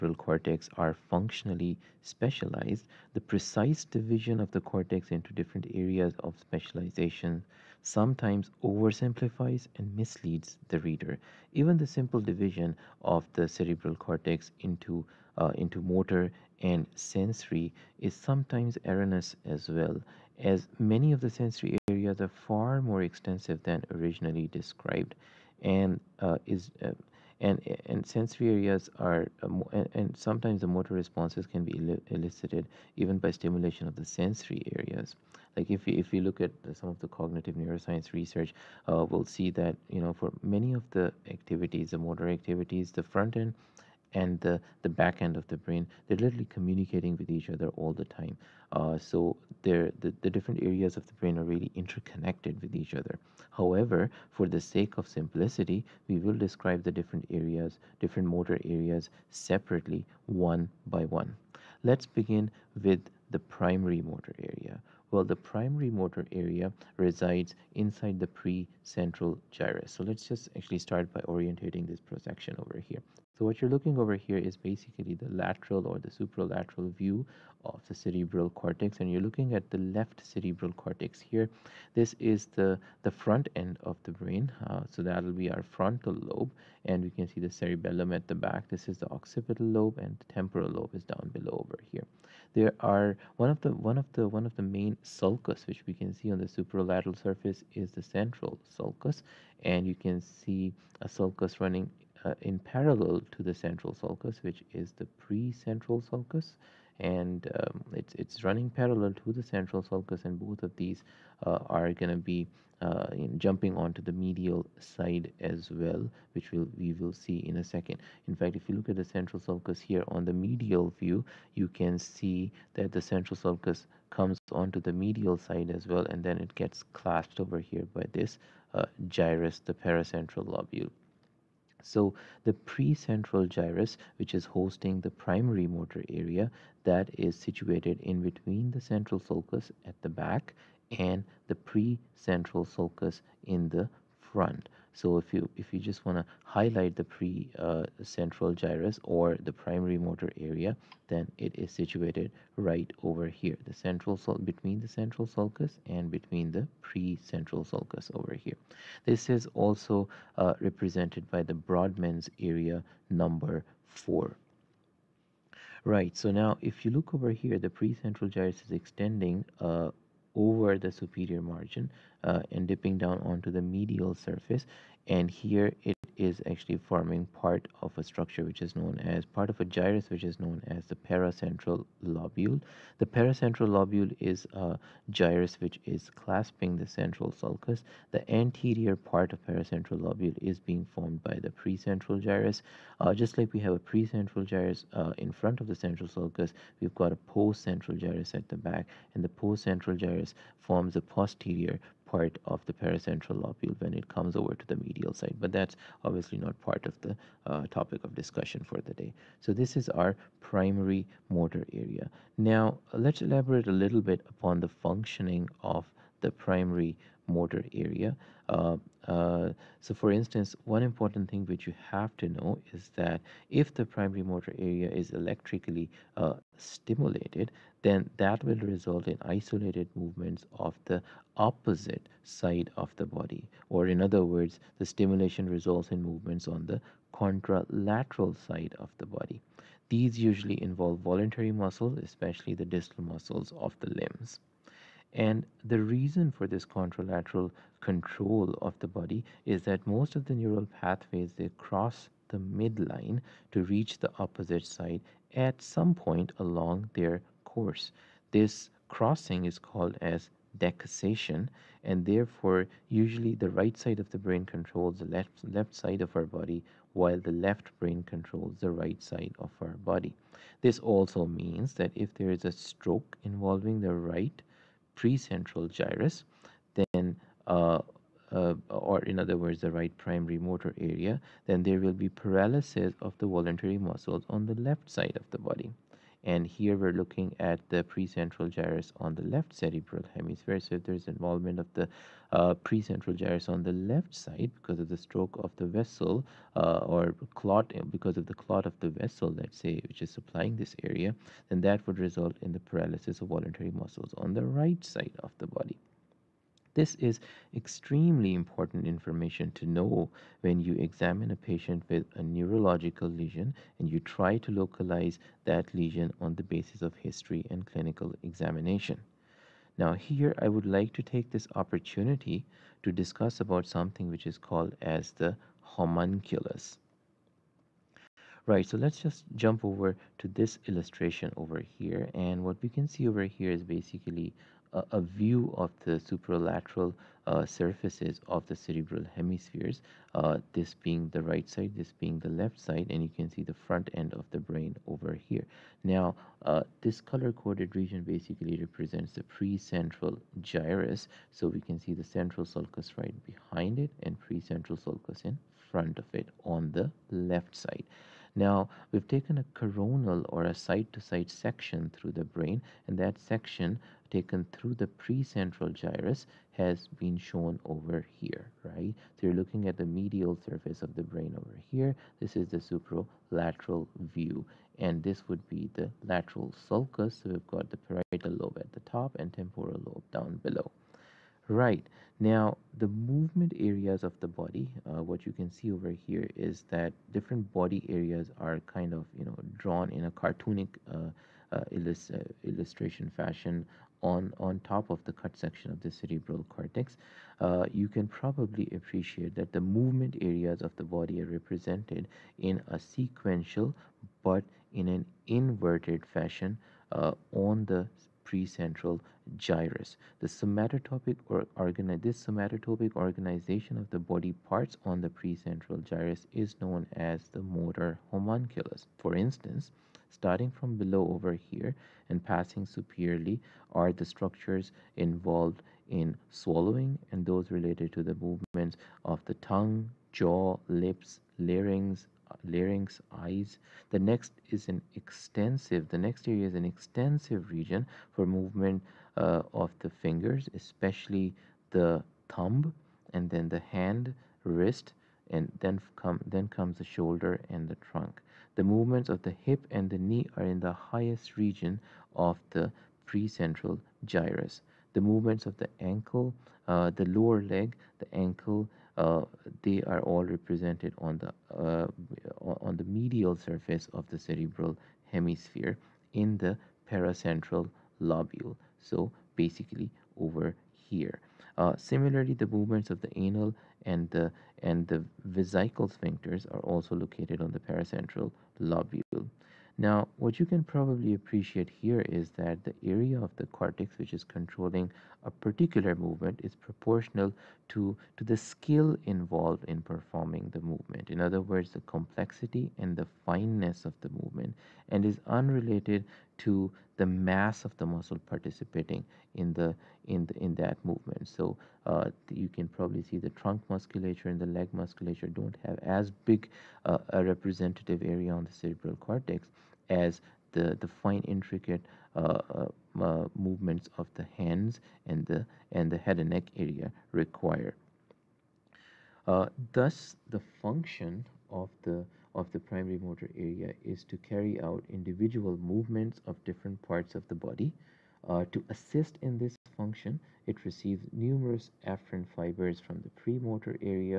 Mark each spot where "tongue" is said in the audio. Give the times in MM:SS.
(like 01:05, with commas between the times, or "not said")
07:09.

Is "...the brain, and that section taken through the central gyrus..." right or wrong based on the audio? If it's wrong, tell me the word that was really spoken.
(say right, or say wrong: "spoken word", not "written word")
wrong: "precentral", not "central".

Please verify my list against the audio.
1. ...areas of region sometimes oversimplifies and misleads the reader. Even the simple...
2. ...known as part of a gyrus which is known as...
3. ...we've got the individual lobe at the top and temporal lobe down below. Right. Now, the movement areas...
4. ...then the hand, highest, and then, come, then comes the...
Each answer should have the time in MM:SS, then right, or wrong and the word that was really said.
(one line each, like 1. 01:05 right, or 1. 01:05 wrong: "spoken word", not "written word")
1. 00:05 wrong: "specialization", not "region"
2. 02:58 right
3. 06:17 wrong: "parietal", not "individual"
4. 07:23 wrong: "wrist", not "highest".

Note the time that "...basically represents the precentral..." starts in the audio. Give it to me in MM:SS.
05:48.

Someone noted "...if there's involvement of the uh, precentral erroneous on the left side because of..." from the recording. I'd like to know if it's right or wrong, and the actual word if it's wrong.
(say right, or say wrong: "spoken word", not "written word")
wrong: "gyrus", not "erroneous".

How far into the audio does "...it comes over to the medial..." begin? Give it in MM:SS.
03:23.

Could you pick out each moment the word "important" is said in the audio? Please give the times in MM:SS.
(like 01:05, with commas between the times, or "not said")
03:40, 05:08.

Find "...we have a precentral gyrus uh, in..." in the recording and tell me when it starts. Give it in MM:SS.
03:13.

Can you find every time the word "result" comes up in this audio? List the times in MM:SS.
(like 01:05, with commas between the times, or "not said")
03:48, 03:55, 05:01.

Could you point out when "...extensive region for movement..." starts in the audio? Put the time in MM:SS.
07:16.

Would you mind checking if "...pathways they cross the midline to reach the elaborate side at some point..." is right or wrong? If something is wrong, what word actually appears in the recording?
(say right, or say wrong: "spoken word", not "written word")
wrong: "opposite", not "elaborate".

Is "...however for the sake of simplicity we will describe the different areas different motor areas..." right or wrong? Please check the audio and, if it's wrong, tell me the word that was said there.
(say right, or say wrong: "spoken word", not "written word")
right.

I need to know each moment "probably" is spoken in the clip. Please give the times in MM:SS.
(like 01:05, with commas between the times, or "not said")
06:38, 08:00, 08:22.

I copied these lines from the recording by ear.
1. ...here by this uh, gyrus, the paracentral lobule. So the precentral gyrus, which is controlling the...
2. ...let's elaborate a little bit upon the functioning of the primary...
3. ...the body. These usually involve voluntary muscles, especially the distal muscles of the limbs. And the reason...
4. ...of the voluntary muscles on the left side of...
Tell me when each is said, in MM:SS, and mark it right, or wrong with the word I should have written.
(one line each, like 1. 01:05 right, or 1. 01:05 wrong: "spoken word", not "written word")
1. 02:07 wrong: "hosting", not "controlling"
2. 03:32 right
3. 03:58 right
4. 04:43 right.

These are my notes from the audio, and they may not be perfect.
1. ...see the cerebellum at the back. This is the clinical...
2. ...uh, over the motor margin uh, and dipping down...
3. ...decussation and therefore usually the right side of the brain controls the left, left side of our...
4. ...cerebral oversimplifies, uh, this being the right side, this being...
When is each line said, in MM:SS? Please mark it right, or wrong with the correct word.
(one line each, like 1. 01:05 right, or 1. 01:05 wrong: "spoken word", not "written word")
1. 01:27 wrong: "occipital", not "clinical"
2. 02:49 wrong: "superior", not "motor"
3. 04:20 right
4. 05:38 wrong: "hemispheres", not "oversimplifies".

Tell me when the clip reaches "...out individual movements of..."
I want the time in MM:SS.
08:44.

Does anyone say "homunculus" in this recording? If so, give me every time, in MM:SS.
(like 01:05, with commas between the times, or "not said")
05:25, 06:58.